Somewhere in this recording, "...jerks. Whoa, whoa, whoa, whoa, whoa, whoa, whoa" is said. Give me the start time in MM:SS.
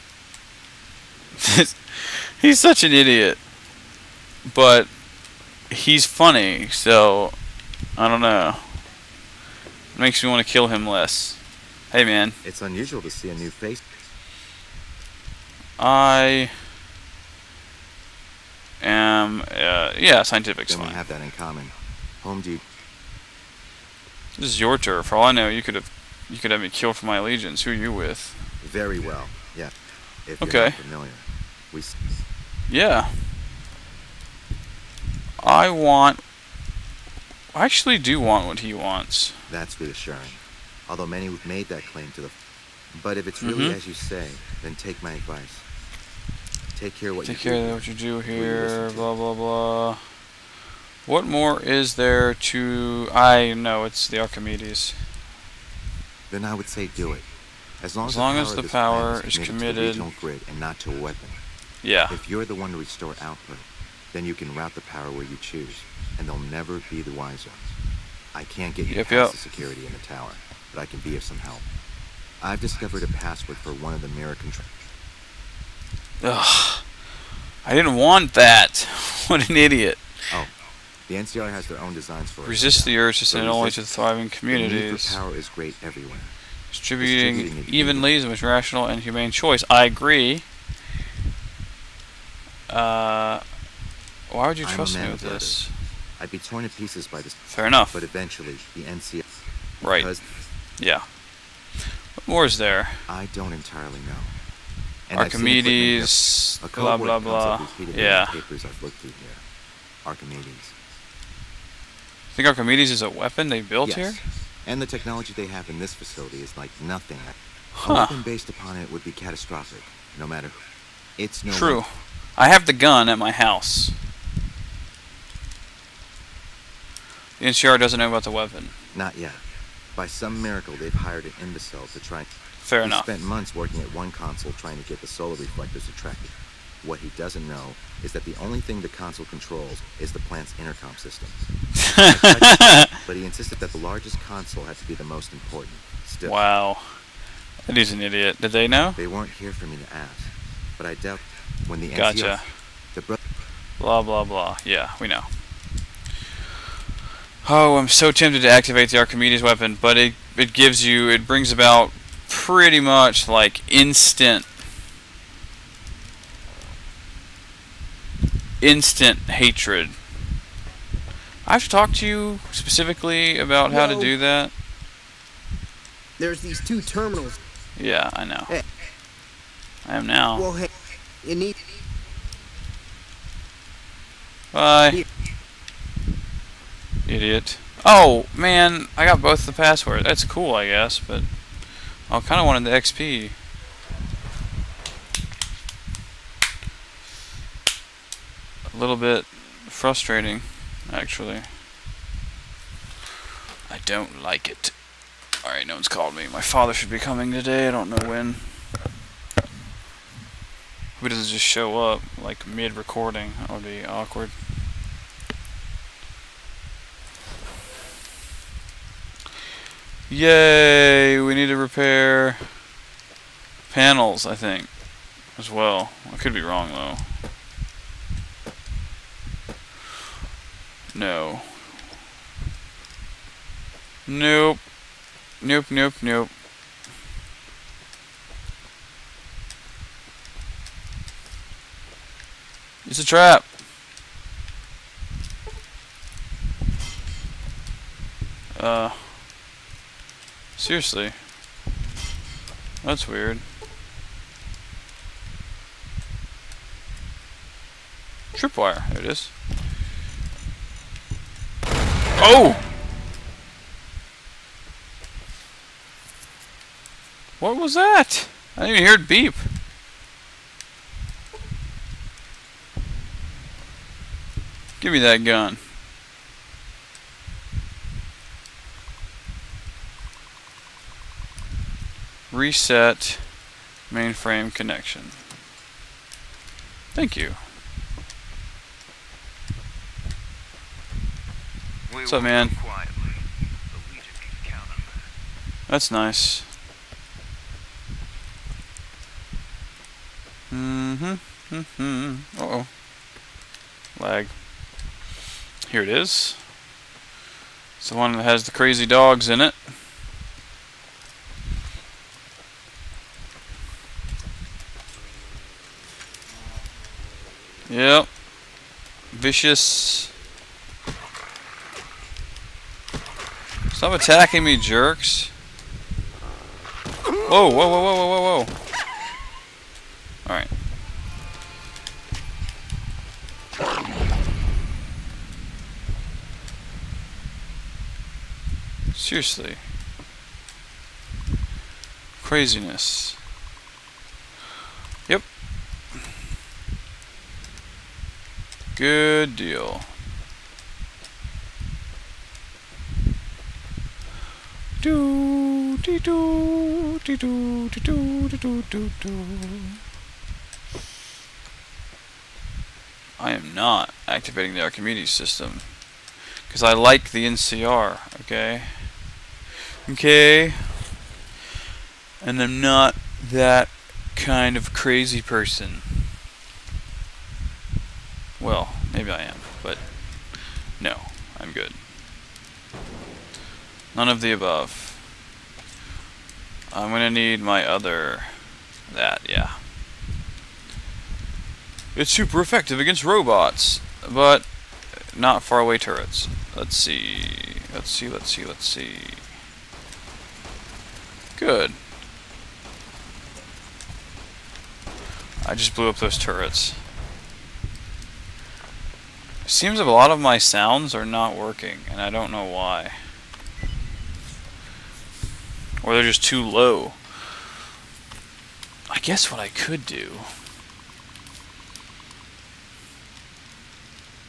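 05:24.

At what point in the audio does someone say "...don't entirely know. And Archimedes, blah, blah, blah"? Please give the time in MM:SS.
01:43.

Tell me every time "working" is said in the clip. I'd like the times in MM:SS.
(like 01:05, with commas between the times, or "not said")
02:13, 06:51.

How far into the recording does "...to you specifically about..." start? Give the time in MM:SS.
02:51.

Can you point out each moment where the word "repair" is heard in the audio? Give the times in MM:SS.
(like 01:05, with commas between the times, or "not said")
03:41.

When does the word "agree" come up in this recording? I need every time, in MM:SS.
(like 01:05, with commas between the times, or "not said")
01:29.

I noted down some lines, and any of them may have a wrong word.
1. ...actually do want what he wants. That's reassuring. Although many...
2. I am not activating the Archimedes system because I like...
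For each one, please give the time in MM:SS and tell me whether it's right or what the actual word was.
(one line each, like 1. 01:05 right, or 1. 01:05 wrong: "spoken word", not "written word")
1. 00:37 right
2. 06:03 right.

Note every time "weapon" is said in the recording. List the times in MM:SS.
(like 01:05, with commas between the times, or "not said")
01:00, 01:53, 01:57, 02:08, 02:39.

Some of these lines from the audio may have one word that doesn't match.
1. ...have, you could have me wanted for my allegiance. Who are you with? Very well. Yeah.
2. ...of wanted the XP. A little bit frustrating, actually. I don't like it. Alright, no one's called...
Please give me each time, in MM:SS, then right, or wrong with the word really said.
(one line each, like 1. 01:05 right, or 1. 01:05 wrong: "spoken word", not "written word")
1. 00:25 wrong: "killed", not "wanted"
2. 03:12 right.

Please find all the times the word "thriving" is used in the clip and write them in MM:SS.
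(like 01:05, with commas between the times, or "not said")
01:23.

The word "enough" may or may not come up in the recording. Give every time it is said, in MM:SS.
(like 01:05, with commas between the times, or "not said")
01:37, 02:12.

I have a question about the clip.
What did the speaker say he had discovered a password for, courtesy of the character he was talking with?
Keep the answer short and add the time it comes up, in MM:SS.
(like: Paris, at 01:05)
One of the mirror controls, at 01:13.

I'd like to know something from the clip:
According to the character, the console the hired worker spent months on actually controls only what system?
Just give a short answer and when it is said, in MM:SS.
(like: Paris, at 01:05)
The plant's intercom system, at 02:20.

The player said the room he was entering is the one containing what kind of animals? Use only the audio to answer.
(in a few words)
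Crazy dogs.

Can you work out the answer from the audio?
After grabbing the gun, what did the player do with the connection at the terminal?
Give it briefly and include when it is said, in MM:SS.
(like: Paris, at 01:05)
Reset mainframe connection, at 04:42.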